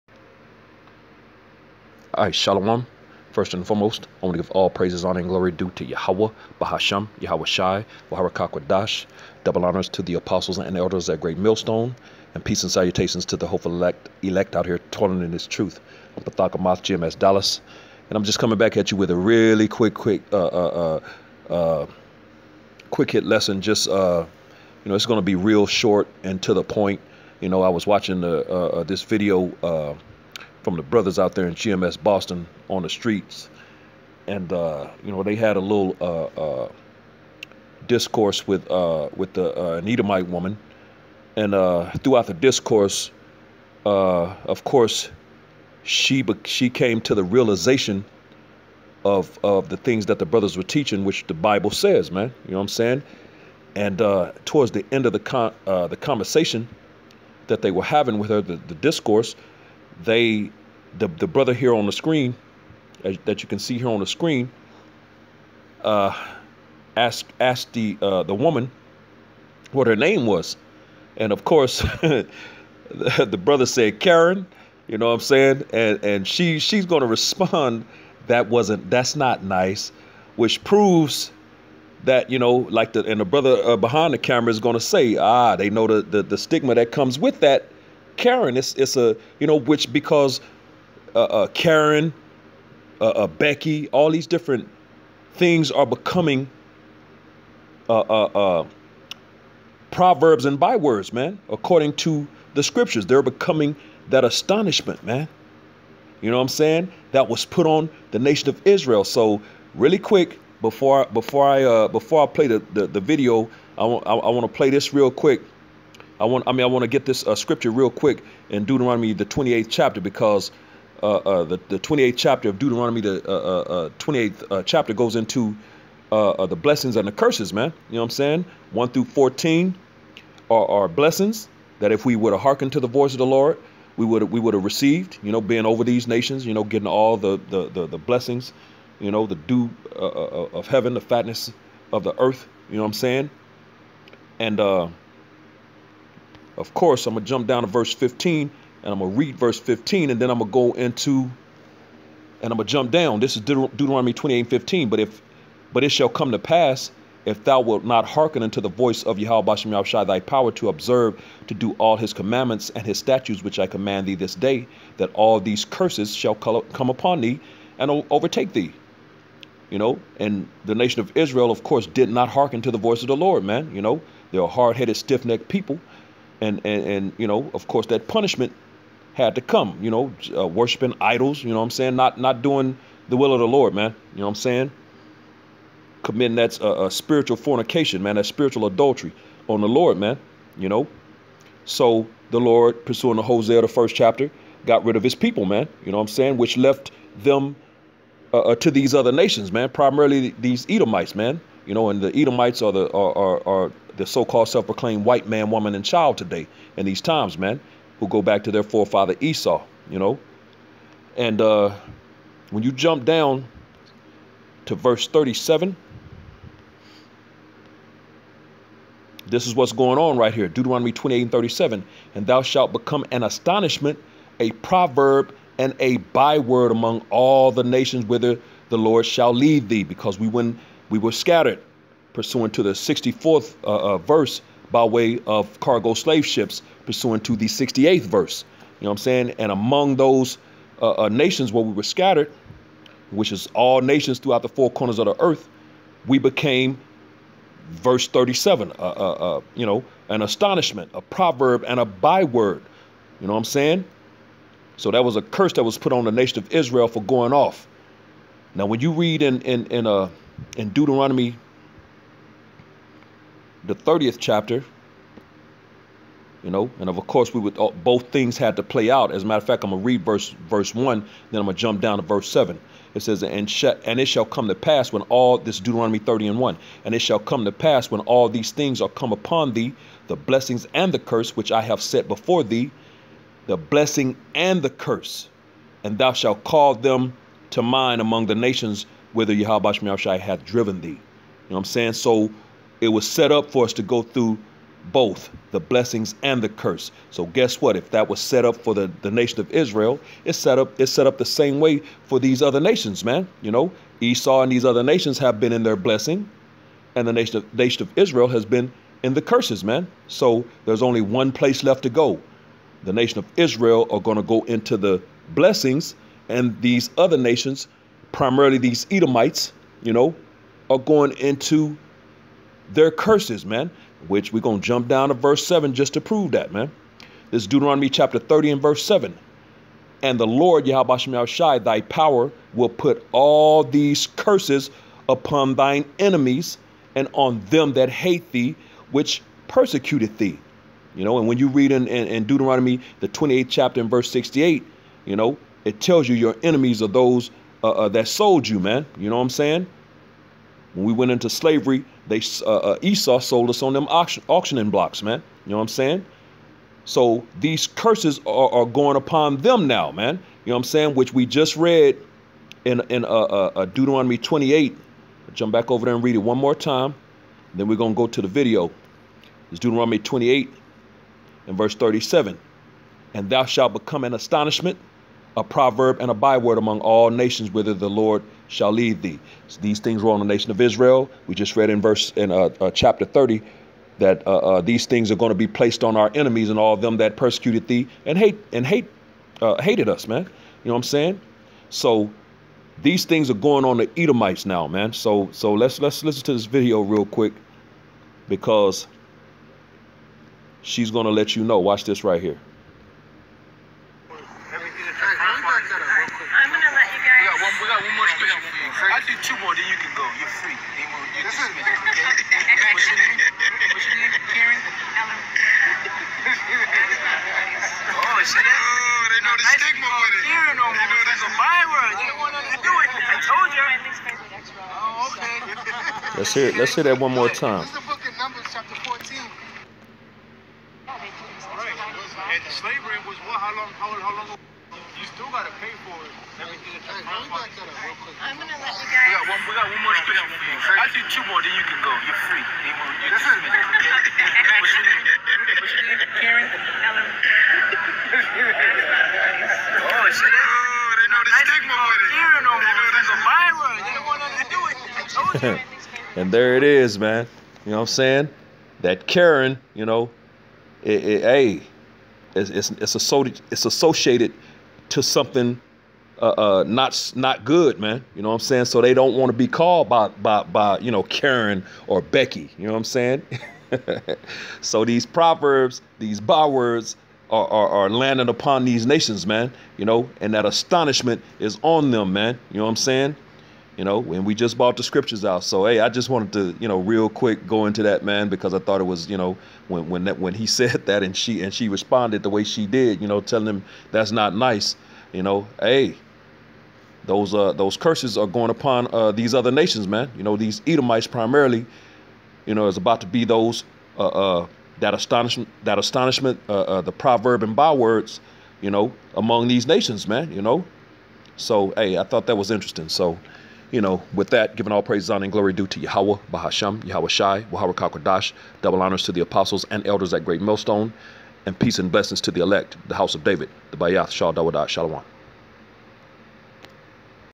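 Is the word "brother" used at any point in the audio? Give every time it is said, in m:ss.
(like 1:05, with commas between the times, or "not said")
0:30, 0:50, 1:01, 1:13, 1:23.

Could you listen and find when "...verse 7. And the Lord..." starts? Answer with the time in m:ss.
5:28.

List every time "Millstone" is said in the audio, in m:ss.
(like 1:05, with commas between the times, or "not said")
0:11, 8:40.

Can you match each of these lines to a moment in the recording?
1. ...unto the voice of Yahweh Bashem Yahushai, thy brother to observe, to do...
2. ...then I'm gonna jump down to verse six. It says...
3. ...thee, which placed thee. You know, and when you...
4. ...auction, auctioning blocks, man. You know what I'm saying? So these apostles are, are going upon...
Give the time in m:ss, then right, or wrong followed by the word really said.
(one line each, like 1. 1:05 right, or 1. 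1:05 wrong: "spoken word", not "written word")
1. 2:38 wrong: "power", not "brother"
2. 4:31 wrong: "seven", not "six"
3. 5:38 wrong: "persecuted", not "placed"
4. 5:53 wrong: "curses", not "apostles".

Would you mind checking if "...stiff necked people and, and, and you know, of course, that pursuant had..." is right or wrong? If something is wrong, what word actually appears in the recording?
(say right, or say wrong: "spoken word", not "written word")
wrong: "punishment", not "pursuant".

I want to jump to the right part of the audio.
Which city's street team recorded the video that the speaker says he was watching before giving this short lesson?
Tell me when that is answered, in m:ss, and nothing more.
0:32.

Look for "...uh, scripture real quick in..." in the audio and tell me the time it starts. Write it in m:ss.
1:57.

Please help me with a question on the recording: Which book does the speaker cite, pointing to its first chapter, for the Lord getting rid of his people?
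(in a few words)
Hosea.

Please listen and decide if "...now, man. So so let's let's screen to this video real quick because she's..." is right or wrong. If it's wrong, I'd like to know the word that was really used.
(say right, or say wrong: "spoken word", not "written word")
wrong: "listen", not "screen".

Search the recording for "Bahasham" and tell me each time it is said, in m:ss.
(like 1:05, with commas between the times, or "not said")
0:06, 8:36.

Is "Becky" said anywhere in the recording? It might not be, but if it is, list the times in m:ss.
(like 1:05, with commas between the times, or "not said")
1:33, 7:52.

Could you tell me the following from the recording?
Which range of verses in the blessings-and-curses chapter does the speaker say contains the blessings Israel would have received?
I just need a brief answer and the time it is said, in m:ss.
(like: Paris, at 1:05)
1 through 14, at 2:08.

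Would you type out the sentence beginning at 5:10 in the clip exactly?
So there's only one place left to go.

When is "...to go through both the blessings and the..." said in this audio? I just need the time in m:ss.
4:53.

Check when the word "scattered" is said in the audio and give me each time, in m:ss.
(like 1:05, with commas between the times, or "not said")
3:51, 4:01.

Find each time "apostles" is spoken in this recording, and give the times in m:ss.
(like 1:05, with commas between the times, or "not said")
0:10, 8:39.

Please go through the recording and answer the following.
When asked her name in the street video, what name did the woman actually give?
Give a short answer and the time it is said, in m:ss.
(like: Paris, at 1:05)
Ellen, at 7:26.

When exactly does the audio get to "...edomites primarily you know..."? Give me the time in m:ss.
8:20.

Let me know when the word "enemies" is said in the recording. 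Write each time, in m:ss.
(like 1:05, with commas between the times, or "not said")
5:35, 5:46, 6:26.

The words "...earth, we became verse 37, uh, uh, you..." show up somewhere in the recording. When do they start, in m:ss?
4:05.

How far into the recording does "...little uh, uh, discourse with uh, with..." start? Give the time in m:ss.
0:35.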